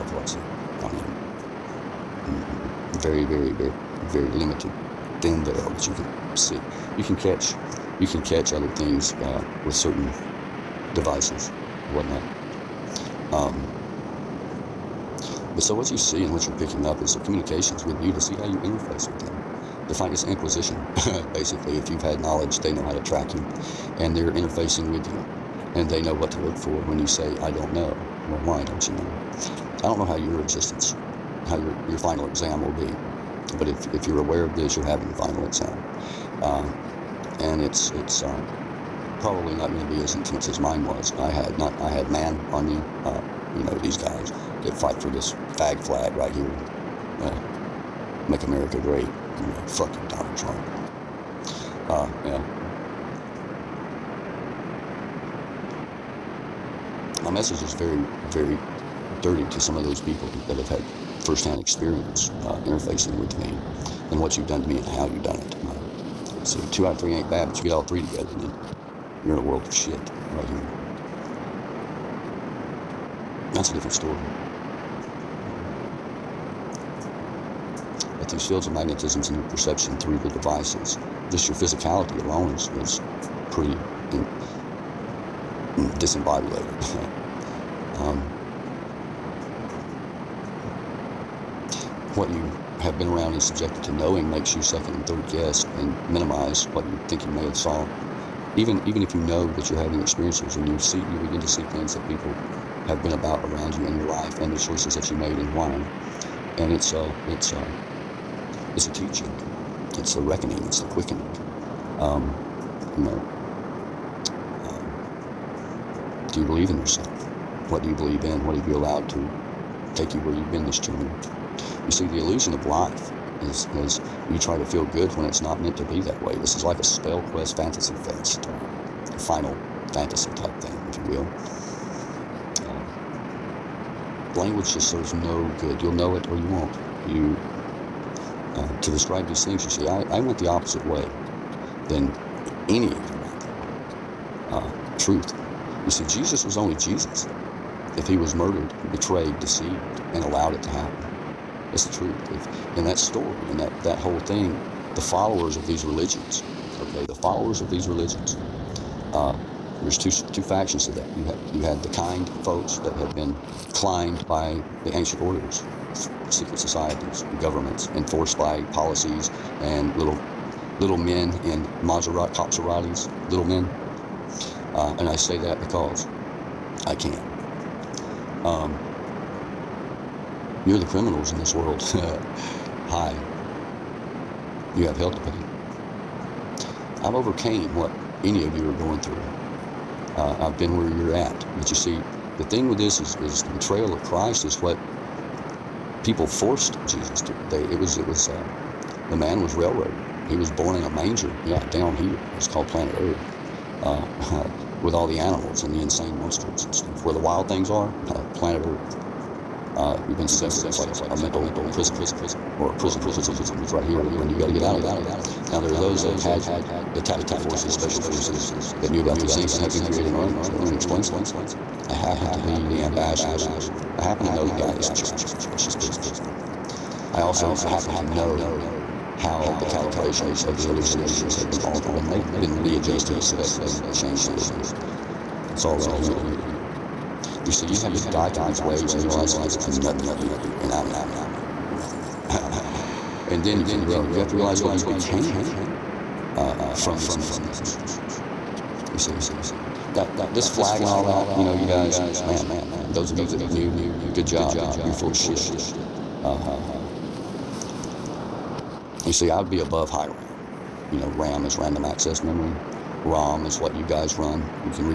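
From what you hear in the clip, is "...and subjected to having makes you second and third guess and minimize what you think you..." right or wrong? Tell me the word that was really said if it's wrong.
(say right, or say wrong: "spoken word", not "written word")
wrong: "knowing", not "having".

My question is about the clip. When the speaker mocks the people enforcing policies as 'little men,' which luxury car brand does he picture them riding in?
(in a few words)
Maserati.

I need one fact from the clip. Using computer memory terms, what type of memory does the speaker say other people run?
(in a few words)
ROM.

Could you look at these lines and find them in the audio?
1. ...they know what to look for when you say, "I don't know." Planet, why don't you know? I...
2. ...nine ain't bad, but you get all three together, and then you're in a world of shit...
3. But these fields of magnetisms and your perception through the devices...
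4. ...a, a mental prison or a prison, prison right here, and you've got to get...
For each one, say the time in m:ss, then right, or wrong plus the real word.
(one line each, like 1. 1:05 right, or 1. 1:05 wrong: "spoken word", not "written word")
1. 0:25 wrong: "Well", not "Planet"
2. 1:06 wrong: "three", not "nine"
3. 1:18 right
4. 3:30 right.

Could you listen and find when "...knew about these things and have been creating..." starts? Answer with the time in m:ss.
3:38.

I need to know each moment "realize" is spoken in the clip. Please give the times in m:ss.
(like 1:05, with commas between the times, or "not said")
3:59, 4:04.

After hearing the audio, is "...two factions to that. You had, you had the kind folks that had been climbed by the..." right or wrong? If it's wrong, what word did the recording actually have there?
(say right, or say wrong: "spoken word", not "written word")
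right.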